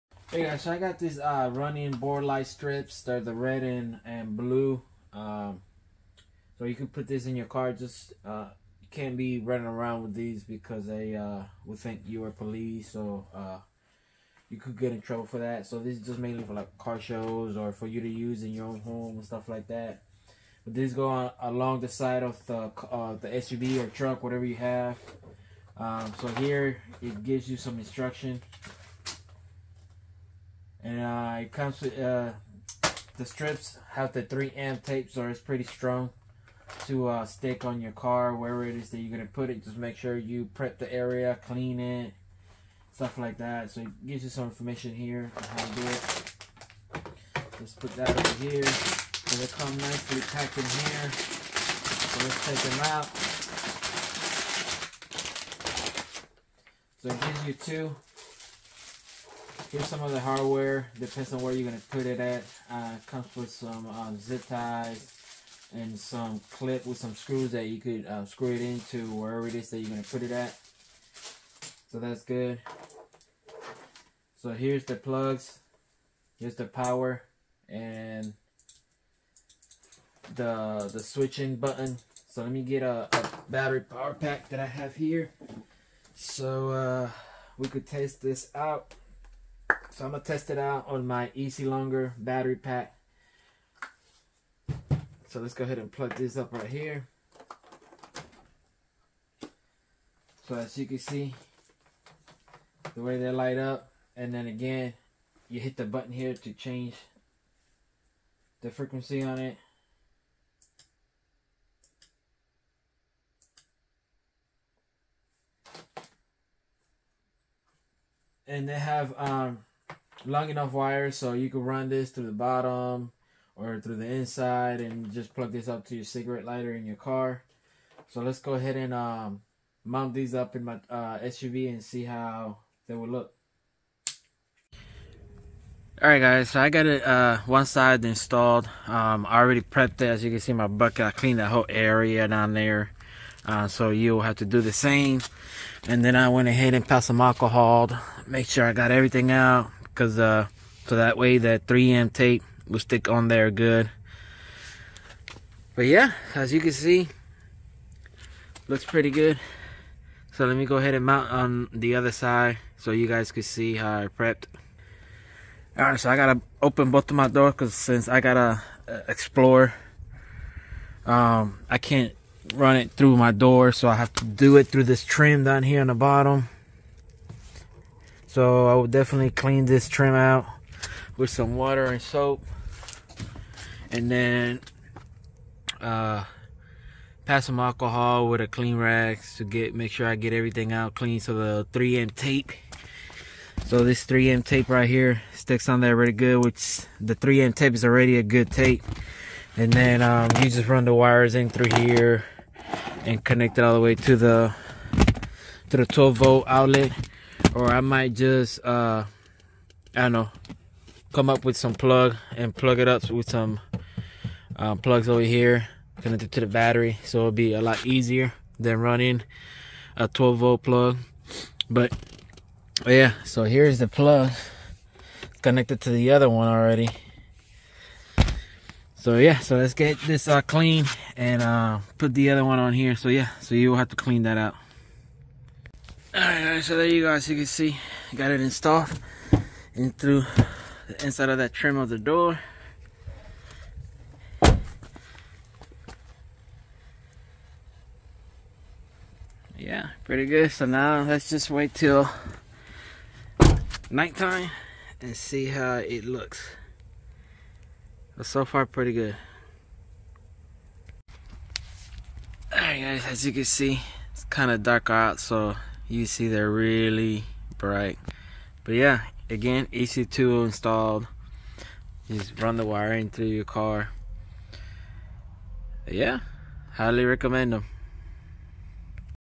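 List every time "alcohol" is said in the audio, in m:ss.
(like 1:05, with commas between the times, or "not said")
2:27, 3:07.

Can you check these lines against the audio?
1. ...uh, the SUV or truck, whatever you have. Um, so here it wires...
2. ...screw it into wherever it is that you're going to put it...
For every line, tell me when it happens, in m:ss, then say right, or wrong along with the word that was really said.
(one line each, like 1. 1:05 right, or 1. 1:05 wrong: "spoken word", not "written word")
1. 0:22 wrong: "gives", not "wires"
2. 1:08 right.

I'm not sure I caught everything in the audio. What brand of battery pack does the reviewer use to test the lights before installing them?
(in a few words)
Easy Longer.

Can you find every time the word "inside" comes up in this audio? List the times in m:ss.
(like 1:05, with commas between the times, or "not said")
2:04, 4:01.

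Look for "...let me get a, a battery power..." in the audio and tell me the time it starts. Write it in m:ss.
1:22.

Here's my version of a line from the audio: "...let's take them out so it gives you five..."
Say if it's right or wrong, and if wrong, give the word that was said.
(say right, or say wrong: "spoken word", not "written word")
wrong: "two", not "five".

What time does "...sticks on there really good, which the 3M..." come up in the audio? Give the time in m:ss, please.
3:15.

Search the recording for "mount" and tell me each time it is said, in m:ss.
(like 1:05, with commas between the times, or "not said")
2:09, 2:41.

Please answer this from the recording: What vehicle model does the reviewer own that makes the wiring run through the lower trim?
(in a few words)
Explorer.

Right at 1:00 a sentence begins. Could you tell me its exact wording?
Depends on where you're going to put it at.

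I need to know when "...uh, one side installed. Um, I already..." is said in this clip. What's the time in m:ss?
2:17.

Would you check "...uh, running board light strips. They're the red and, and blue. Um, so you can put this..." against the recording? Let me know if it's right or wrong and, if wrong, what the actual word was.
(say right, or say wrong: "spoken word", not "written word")
right.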